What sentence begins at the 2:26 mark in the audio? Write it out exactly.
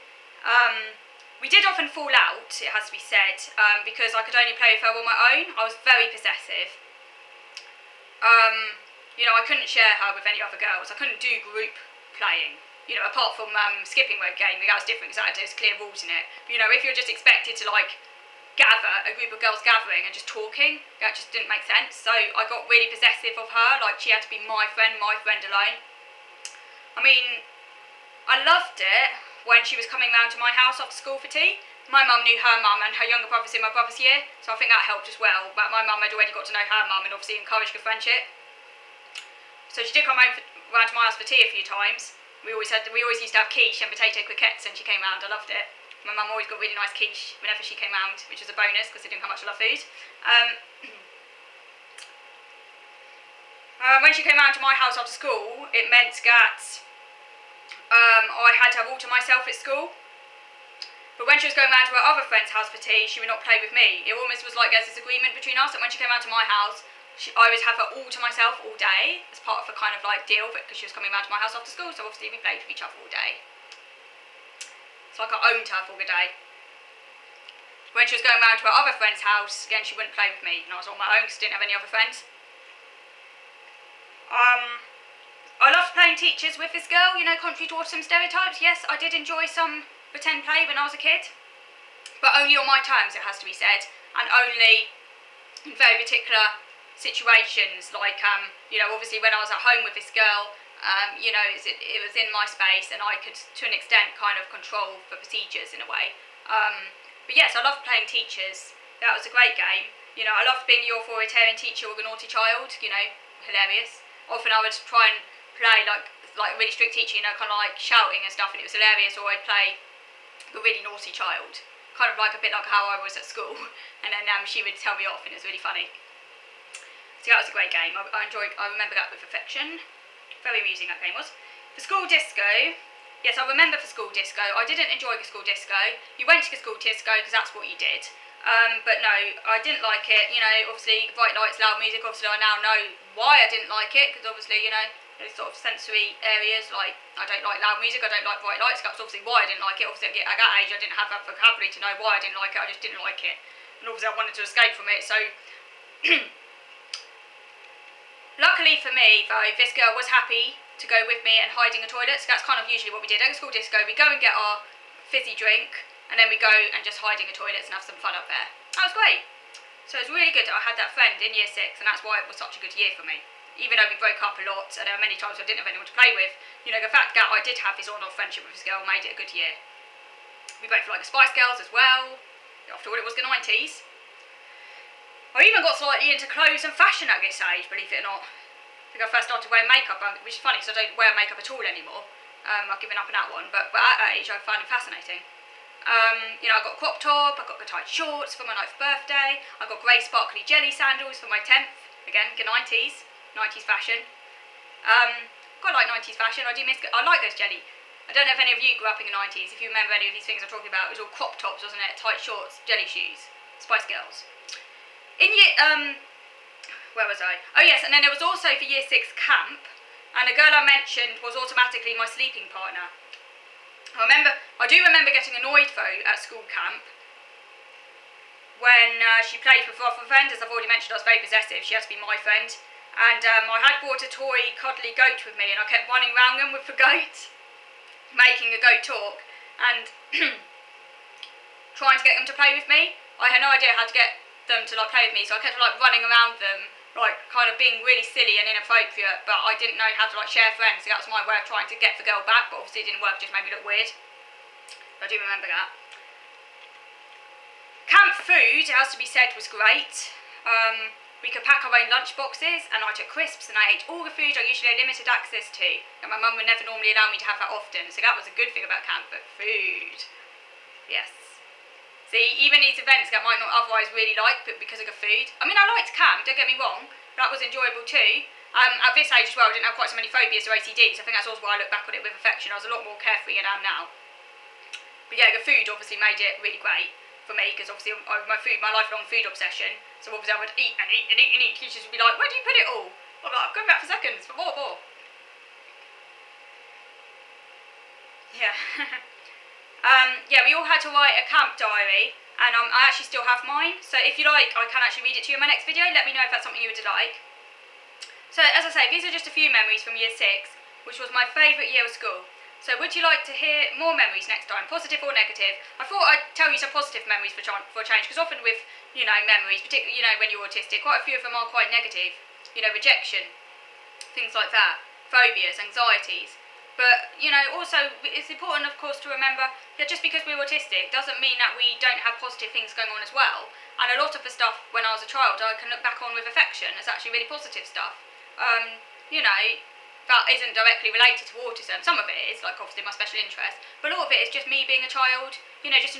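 Like, I don't like loud music.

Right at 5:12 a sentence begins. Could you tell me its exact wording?
So would you like to hear more memories next time, positive or negative?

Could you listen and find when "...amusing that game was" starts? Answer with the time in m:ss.
2:10.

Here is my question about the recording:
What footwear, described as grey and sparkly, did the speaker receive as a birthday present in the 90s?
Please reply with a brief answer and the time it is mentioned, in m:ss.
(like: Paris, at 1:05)
Jelly sandals, at 3:20.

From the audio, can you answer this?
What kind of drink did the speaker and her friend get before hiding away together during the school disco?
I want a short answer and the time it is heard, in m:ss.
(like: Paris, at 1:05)
Fizzy drink, at 2:45.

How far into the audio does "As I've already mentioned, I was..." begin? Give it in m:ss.
3:50.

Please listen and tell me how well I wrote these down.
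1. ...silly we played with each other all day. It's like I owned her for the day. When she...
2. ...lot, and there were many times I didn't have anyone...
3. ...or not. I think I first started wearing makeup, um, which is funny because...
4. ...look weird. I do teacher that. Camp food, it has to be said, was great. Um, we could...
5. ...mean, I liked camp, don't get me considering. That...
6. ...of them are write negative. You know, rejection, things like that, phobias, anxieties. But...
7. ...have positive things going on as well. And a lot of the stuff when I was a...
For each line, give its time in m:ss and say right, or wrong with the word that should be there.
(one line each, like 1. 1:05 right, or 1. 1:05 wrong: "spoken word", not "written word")
1. 1:12 wrong: "obviously", not "silly"
2. 2:54 right
3. 3:08 right
4. 4:13 wrong: "remember", not "teacher"
5. 4:35 wrong: "wrong", not "considering"
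6. 5:21 wrong: "quite", not "write"
7. 5:31 right.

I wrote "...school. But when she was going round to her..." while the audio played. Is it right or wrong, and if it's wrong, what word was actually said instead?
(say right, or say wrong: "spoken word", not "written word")
right.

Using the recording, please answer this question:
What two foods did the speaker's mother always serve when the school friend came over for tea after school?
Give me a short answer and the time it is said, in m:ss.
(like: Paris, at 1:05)
Quiche and potato croquettes, at 0:43.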